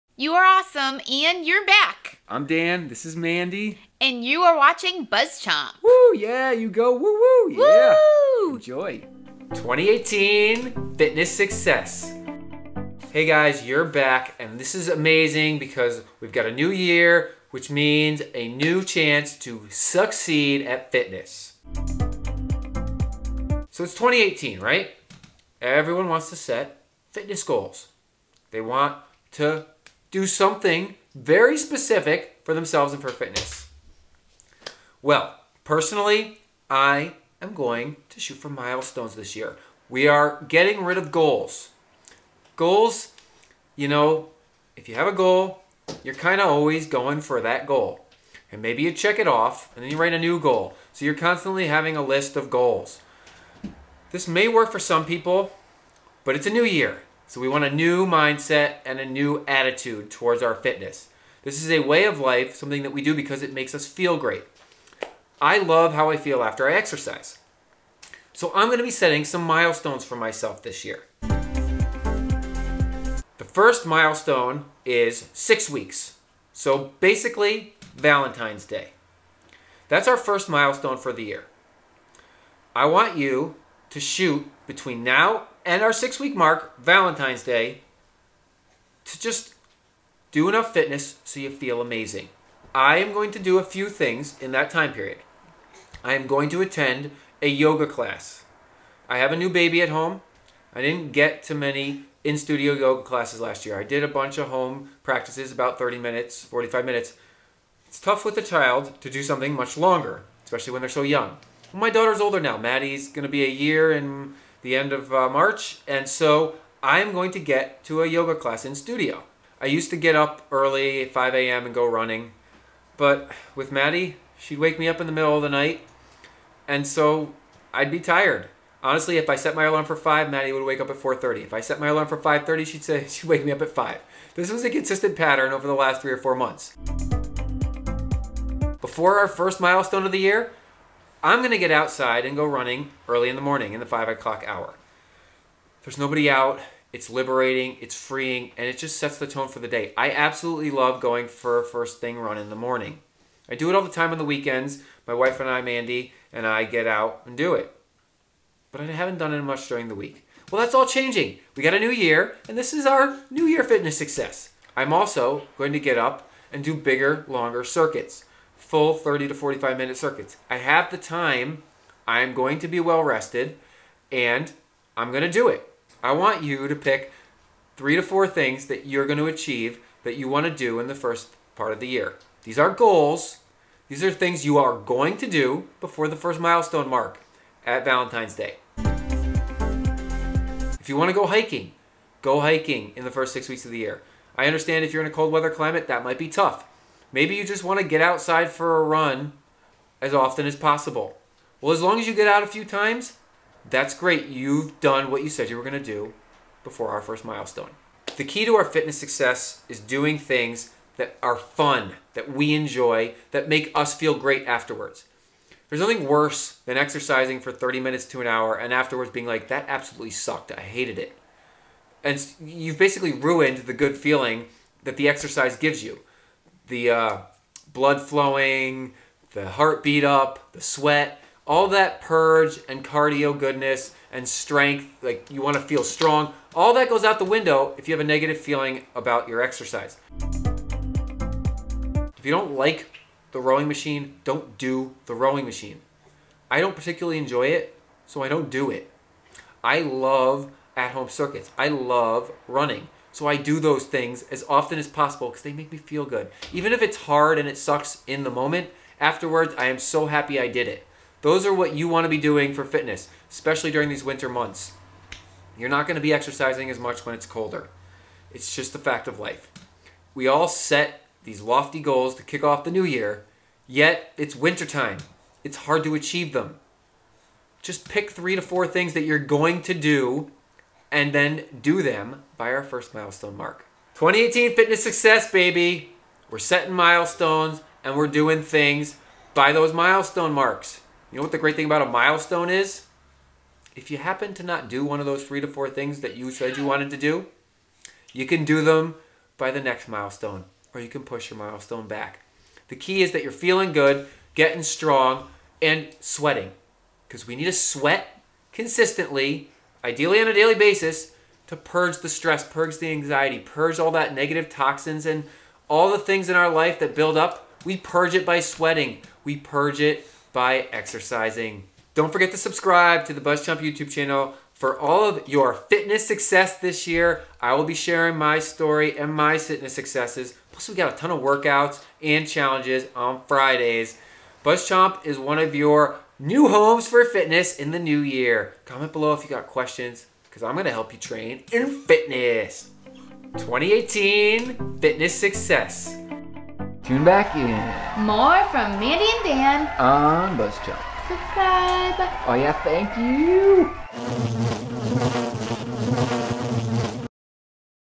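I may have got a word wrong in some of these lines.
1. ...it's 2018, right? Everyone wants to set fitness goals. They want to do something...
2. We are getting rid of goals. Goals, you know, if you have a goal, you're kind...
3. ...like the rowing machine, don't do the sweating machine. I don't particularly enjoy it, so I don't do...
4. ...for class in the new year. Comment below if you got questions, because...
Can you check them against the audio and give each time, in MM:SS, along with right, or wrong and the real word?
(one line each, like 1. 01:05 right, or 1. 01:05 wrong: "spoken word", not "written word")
1. 00:23 right
2. 00:39 right
3. 04:02 wrong: "rowing", not "sweating"
4. 05:36 wrong: "fitness", not "class".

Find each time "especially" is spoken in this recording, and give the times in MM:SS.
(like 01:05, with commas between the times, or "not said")
01:50, 04:23.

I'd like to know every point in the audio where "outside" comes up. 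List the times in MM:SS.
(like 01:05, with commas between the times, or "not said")
02:21, 03:18.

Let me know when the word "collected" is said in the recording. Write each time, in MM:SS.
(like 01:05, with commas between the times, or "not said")
not said.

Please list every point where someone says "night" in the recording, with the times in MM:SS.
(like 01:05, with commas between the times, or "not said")
02:05.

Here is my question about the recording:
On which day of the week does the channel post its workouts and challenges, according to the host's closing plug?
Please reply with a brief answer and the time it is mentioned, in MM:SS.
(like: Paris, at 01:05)
Fridays, at 05:33.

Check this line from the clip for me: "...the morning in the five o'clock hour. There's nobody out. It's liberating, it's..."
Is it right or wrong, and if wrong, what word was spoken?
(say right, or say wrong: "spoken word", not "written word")
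right.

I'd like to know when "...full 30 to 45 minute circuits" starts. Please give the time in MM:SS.
02:48.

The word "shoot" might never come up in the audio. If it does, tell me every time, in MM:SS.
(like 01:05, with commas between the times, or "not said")
00:38, 01:24.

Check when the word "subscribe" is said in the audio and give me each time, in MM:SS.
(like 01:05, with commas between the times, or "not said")
05:22, 05:51.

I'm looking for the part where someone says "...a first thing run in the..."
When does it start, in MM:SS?
02:31.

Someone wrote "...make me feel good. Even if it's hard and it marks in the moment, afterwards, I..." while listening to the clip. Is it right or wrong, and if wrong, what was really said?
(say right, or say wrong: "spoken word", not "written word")
wrong: "sucks", not "marks".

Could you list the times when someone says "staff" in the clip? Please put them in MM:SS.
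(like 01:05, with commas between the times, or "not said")
not said.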